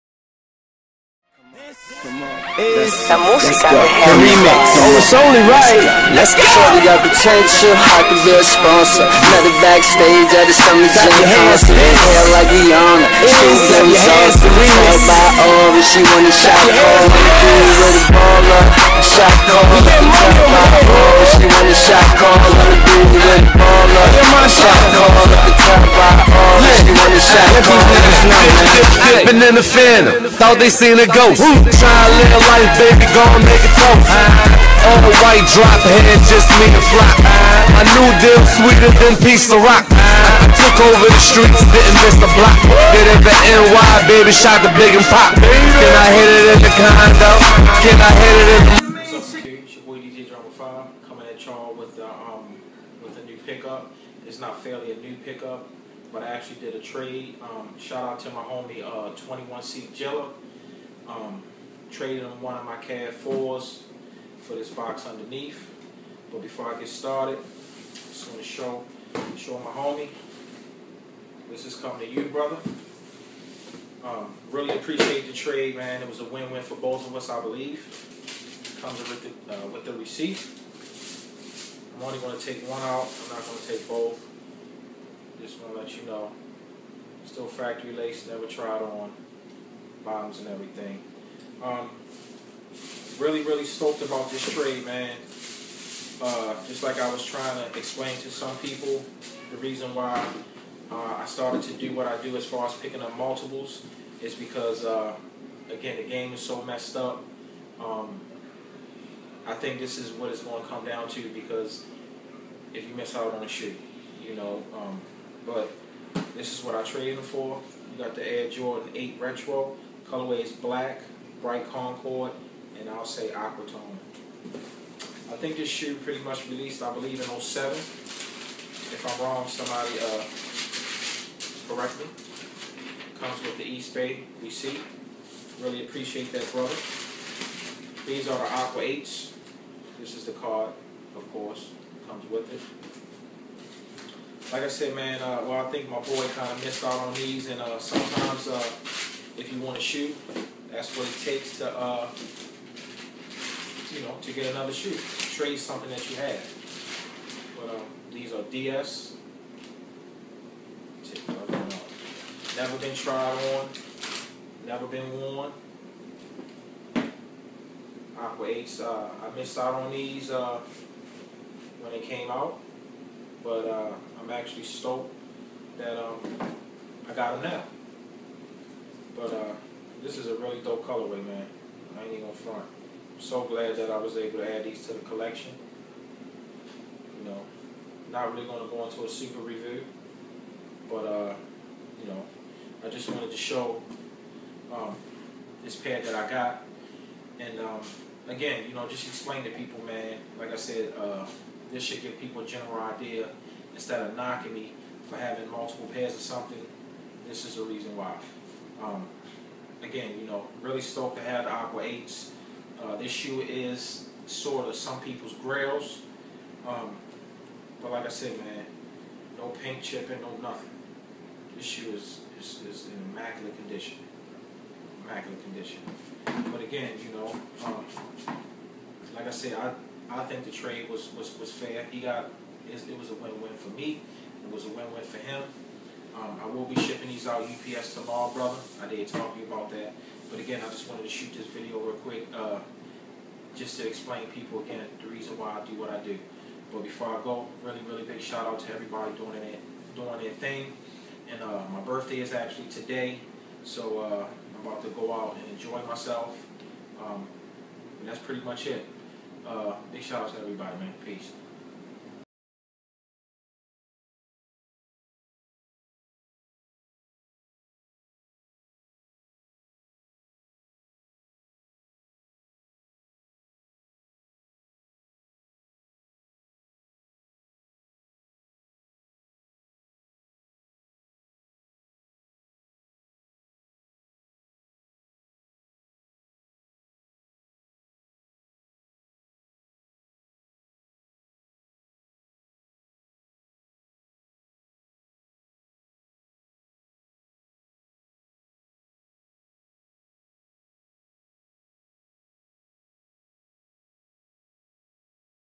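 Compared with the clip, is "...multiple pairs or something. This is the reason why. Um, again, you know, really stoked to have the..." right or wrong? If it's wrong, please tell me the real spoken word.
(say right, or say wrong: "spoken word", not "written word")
right.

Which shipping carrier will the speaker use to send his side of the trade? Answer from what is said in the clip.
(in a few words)
UPS.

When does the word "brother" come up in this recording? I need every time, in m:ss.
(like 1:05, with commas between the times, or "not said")
1:12, 2:16, 3:58.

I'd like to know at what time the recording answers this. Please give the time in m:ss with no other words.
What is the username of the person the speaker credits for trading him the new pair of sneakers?
0:59.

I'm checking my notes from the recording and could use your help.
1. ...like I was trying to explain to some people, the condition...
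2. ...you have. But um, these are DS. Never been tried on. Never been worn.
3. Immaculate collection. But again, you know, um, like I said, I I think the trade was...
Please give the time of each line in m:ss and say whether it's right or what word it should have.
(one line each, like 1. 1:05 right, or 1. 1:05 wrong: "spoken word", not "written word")
1. 1:36 wrong: "reason", not "condition"
2. 2:36 right
3. 3:45 wrong: "condition", not "collection".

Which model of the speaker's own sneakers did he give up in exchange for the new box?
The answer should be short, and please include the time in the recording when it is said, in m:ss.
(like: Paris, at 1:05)
CAD 4s, at 1:02.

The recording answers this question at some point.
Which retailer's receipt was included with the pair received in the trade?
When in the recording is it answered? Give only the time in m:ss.
2:13.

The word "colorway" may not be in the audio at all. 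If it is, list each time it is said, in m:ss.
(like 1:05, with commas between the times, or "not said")
2:00, 3:00.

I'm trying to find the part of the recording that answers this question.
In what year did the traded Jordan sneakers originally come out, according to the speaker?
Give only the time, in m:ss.
2:07.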